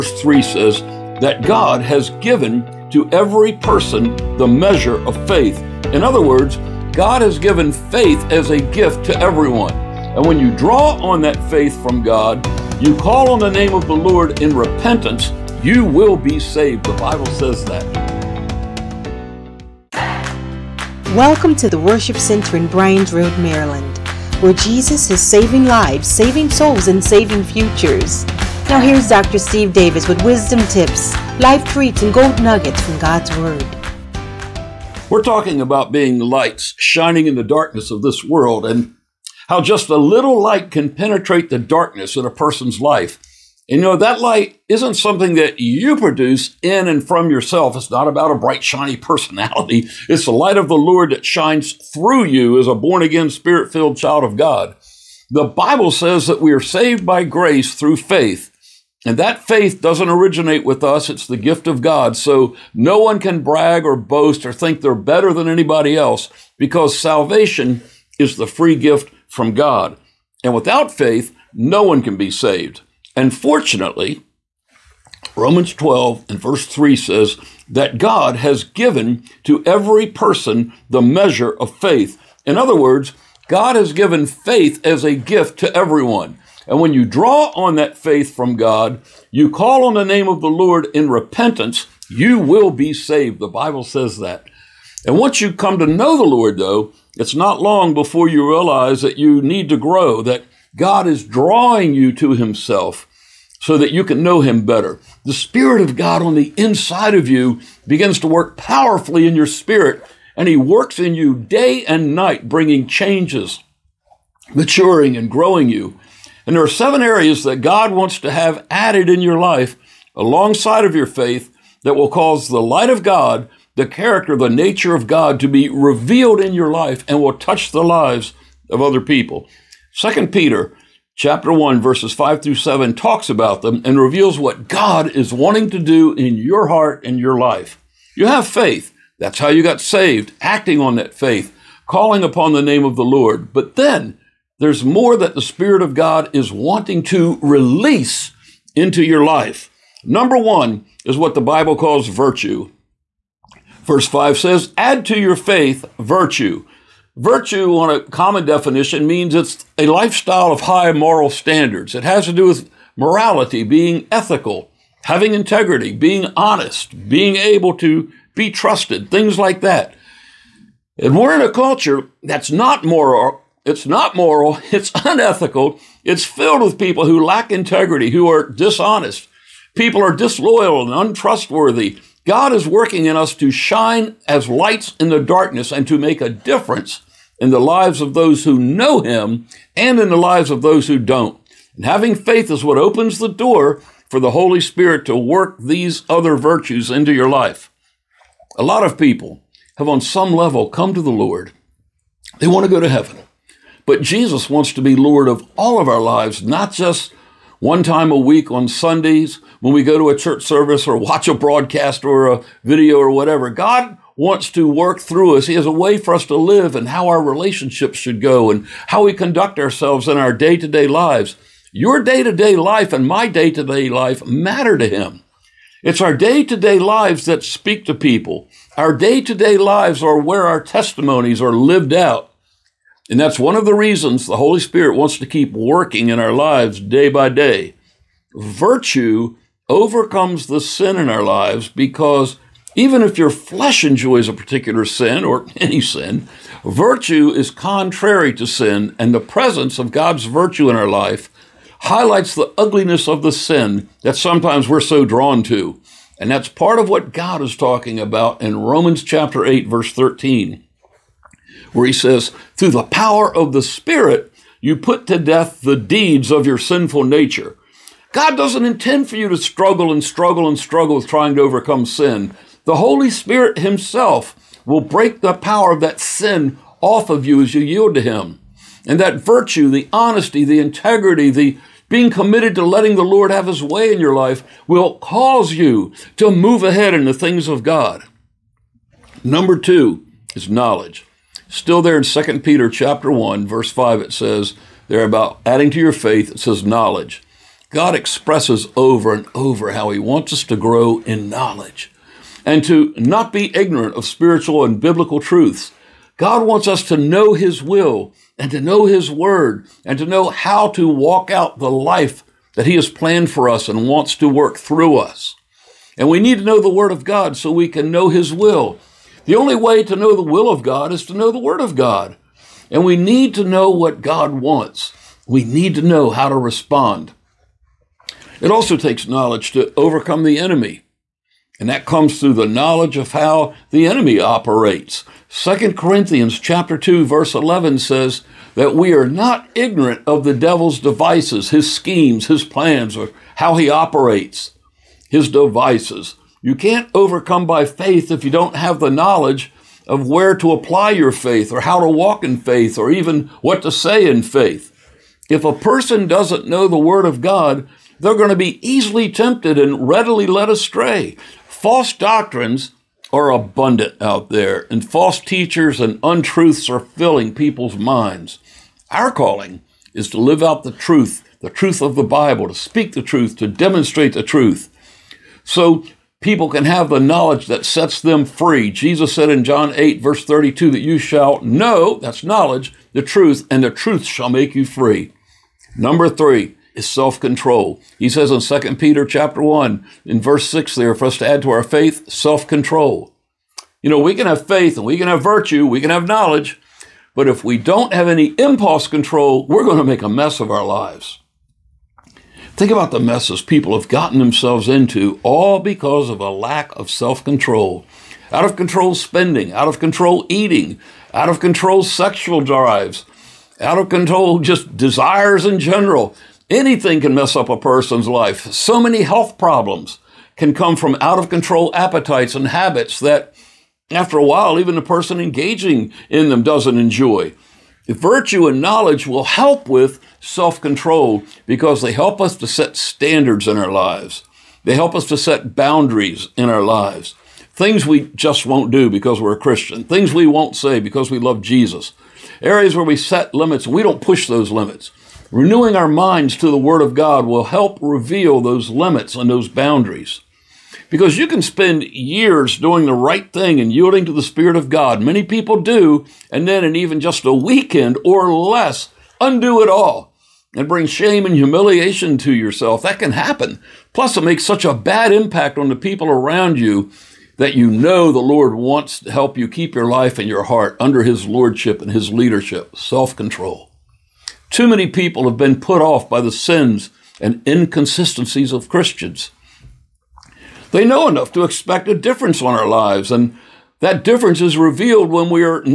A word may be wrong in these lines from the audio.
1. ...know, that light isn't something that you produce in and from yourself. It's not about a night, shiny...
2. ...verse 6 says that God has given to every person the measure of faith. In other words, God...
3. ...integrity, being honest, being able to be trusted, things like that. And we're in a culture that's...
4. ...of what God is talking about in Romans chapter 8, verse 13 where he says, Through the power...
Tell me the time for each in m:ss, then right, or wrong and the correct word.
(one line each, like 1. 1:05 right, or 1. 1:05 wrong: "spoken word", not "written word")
1. 0:43 wrong: "bright", not "night"
2. 1:16 wrong: "3", not "6"
3. 2:45 right
4. 4:16 right.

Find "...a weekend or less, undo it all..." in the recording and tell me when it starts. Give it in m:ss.
7:37.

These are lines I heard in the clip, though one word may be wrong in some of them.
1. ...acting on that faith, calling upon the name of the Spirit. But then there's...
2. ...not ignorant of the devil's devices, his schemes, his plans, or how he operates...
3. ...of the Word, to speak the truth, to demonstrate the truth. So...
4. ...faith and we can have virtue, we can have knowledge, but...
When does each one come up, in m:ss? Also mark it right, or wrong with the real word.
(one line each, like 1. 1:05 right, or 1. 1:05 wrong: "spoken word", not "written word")
1. 2:20 wrong: "Lord", not "Spirit"
2. 5:39 right
3. 6:11 wrong: "Bible", not "Word"
4. 6:34 right.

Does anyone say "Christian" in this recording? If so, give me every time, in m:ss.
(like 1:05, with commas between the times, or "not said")
7:19, 7:58.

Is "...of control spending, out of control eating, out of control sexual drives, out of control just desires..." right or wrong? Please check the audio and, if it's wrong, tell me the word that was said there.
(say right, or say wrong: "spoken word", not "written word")
right.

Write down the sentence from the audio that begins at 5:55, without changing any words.
If a person doesn't know the Word of God, they're going to be easily tempted and readily led astray.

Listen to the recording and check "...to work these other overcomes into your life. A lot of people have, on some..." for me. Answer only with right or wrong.
wrong.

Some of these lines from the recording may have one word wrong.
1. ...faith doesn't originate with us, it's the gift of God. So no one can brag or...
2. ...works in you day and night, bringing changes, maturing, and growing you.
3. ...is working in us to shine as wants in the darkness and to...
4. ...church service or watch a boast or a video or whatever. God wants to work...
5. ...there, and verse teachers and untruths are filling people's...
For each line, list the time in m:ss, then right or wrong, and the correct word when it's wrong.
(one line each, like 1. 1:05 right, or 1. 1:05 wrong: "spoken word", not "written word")
1. 0:59 right
2. 1:50 right
3. 3:02 wrong: "lights", not "wants"
4. 3:30 wrong: "broadcast", not "boast"
5. 6:04 wrong: "false", not "verse".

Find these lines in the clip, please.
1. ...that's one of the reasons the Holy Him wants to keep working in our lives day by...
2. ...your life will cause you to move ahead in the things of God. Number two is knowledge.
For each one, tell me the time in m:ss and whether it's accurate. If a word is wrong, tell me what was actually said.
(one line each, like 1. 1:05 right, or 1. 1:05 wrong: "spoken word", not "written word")
1. 3:53 wrong: "Spirit", not "Him"
2. 4:43 right.